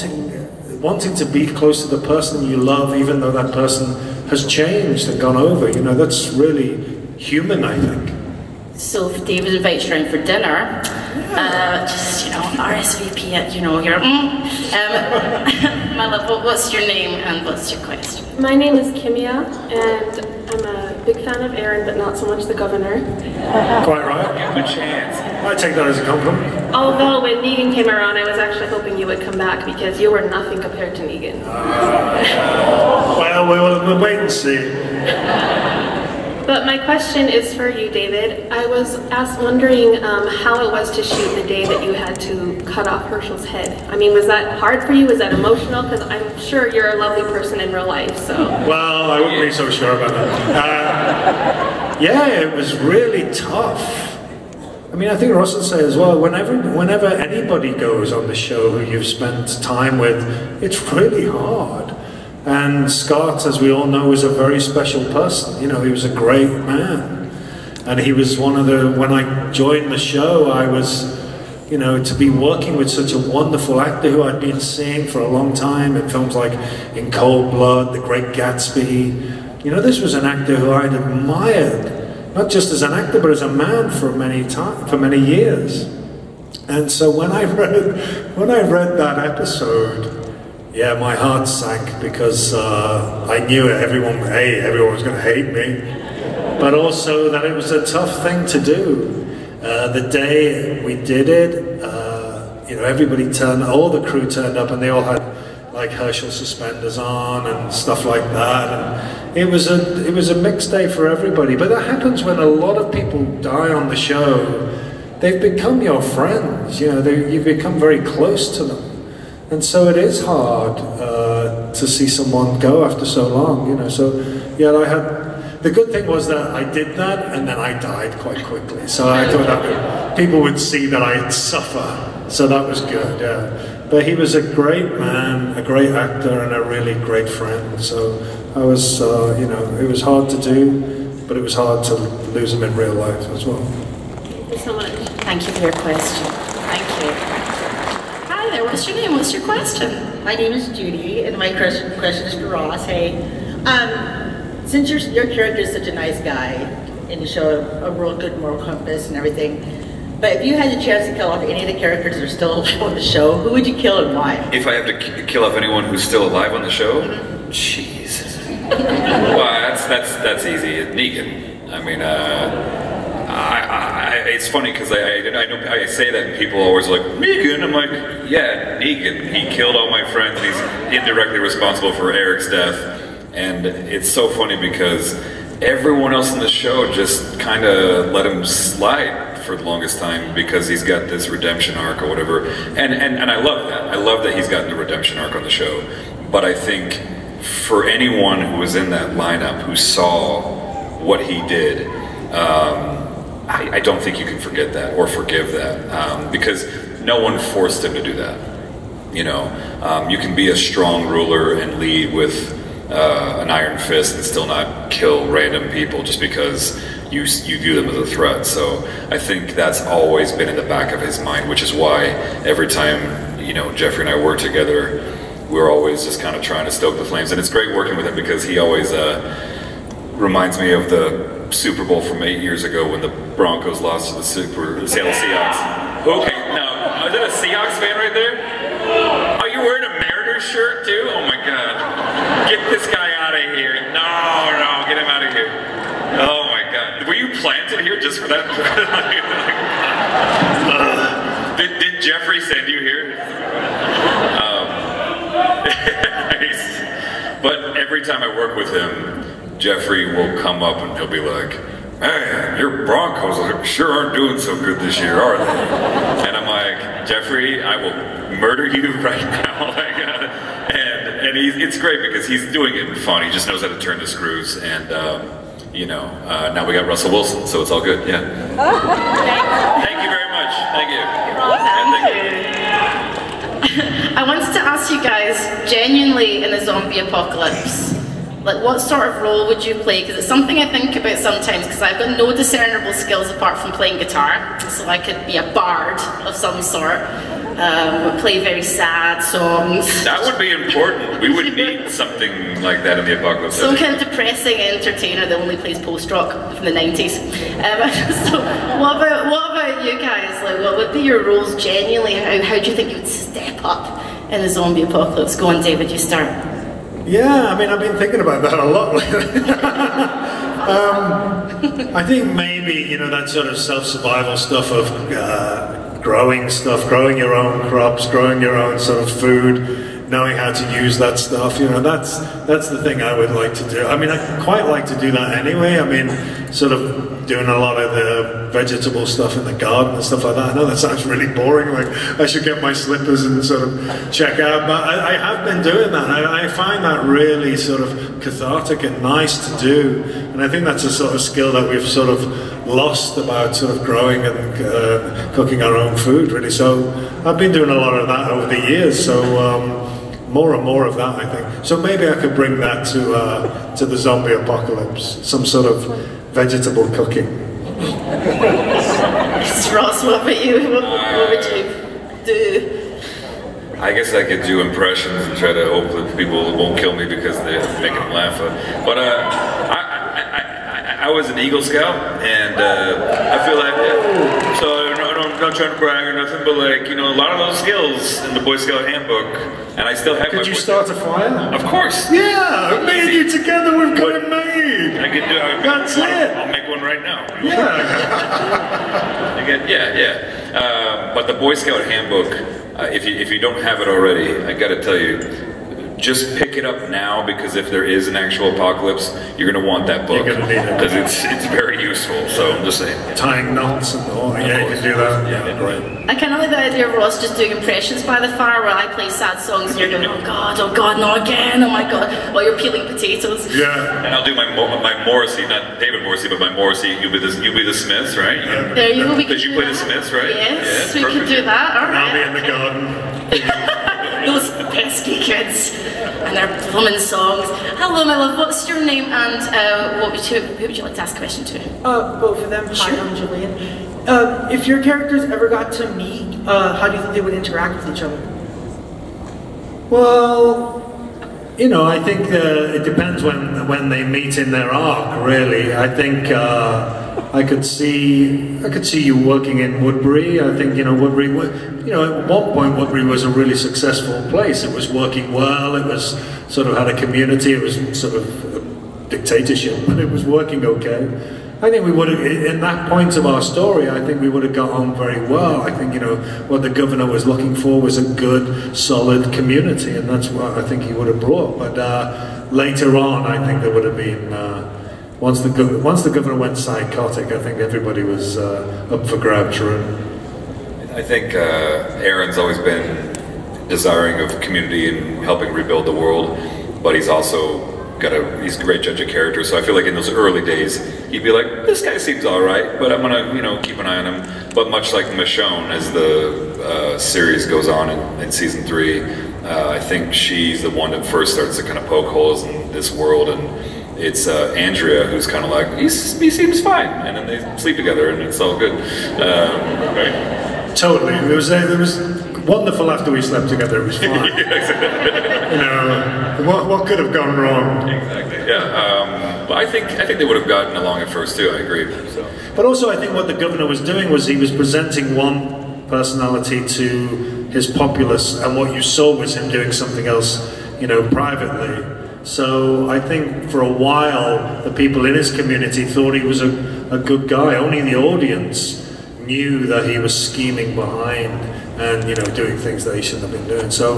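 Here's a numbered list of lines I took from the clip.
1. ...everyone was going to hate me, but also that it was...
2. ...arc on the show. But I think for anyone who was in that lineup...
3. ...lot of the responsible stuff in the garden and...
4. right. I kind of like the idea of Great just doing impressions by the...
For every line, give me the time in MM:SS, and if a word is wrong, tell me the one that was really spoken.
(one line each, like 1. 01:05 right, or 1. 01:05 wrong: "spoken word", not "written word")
1. 01:34 right
2. 03:15 right
3. 05:37 wrong: "vegetable", not "responsible"
4. 06:55 wrong: "Ross", not "Great".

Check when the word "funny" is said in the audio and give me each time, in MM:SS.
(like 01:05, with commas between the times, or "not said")
02:54, 03:04.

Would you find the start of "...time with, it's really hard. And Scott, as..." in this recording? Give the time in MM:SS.
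00:59.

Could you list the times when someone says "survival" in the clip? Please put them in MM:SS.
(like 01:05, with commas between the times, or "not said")
05:23.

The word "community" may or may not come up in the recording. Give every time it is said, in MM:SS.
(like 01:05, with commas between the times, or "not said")
07:46, 07:59, 08:14, 09:05.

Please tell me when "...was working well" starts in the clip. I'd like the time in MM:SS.
07:44.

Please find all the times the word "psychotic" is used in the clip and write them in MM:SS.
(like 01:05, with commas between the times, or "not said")
08:06.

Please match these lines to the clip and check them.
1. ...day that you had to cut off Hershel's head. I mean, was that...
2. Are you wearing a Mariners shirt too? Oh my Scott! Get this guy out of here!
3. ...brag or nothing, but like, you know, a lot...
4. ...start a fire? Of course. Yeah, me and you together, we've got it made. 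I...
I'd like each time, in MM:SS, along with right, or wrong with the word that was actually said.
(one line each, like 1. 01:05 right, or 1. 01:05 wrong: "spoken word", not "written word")
1. 00:41 right
2. 03:59 wrong: "God", not "Scott"
3. 06:25 right
4. 06:30 right.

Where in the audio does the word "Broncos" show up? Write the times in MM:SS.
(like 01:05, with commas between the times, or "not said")
03:53, 04:22.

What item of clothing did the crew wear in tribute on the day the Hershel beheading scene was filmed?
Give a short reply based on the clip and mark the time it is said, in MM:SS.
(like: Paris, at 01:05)
Hershel suspenders, at 01:45.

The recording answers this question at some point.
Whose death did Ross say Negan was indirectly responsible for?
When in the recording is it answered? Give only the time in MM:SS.
03:02.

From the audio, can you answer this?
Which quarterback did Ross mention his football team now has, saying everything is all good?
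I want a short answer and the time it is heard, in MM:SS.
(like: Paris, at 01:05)
Russell Wilson, at 04:36.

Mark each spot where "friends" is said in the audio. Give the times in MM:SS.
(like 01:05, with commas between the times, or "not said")
01:56, 02:17, 03:00.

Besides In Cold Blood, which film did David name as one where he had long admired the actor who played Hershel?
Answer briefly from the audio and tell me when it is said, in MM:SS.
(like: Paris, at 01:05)
The Great Gatsby, at 01:17.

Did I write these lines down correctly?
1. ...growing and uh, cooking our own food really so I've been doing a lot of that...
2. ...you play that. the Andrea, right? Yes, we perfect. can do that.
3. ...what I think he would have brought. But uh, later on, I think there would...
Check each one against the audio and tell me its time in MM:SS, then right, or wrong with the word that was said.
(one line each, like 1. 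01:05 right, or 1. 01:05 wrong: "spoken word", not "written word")
1. 05:53 right
2. 07:09 wrong: "Smiths", not "Andrea"
3. 08:00 right.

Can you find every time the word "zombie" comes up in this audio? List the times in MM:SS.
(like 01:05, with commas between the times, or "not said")
04:46, 05:14, 06:03.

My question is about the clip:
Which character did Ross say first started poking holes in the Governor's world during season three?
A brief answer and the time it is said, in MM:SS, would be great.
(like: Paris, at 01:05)
Michonne, at 08:25.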